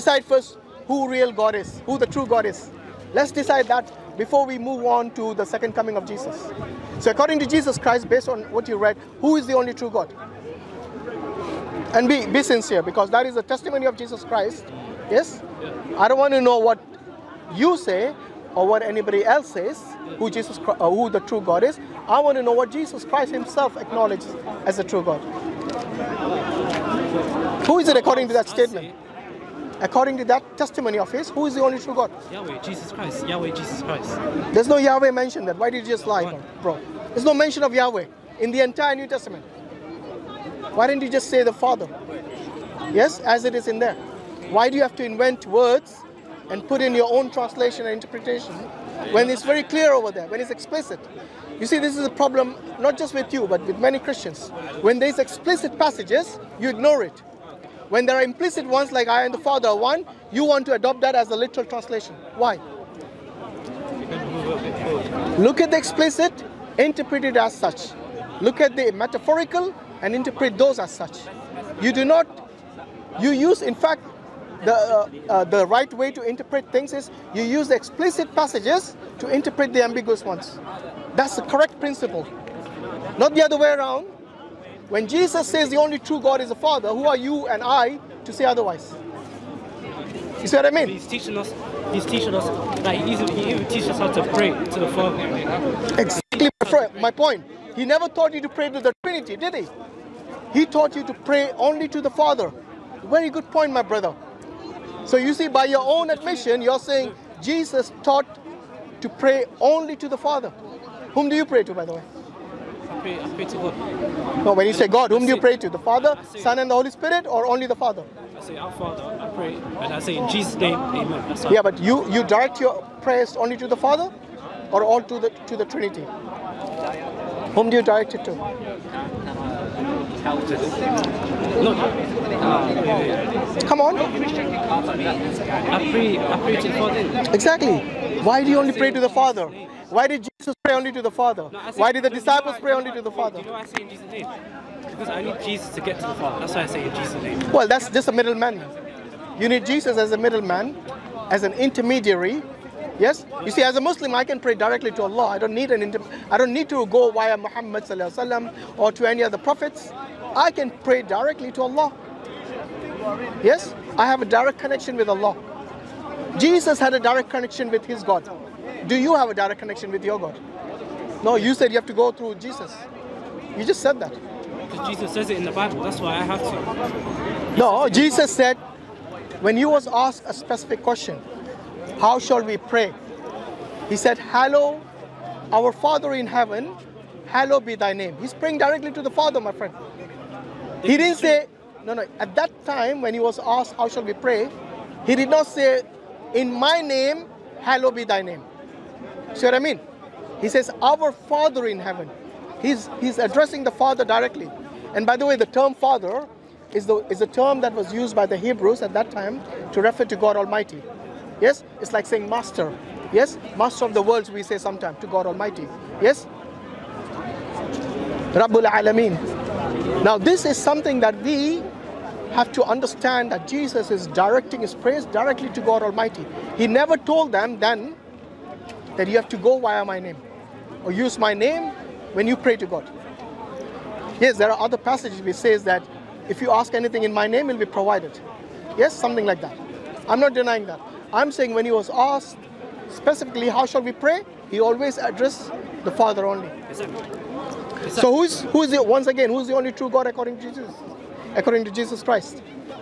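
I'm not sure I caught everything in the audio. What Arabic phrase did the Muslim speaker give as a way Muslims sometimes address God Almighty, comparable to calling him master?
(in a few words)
Rabbul Alameen.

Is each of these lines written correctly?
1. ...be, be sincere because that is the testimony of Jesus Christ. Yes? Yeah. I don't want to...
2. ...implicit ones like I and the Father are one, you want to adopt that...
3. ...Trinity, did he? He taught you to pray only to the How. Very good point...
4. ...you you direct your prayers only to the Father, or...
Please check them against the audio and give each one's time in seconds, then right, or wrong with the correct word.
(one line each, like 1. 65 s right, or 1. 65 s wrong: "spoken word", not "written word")
1. 12 s right
2. 58 s right
3. 99 s wrong: "Father", not "How"
4. 121 s right.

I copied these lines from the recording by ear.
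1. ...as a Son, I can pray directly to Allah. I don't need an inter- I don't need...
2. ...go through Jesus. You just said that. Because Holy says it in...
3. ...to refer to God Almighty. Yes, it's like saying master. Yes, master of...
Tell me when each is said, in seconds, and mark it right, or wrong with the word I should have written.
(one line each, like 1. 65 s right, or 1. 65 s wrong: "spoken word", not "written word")
1. 153 s wrong: "Muslim", not "Son"
2. 171 s wrong: "Jesus", not "Holy"
3. 209 s right.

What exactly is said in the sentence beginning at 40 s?
Why didn't you just say the Father?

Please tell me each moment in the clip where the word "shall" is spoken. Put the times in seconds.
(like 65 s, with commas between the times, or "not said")
182 s, 193 s, 243 s.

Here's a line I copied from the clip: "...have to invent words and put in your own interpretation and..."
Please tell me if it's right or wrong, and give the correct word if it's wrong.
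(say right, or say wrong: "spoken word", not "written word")
wrong: "translation", not "interpretation".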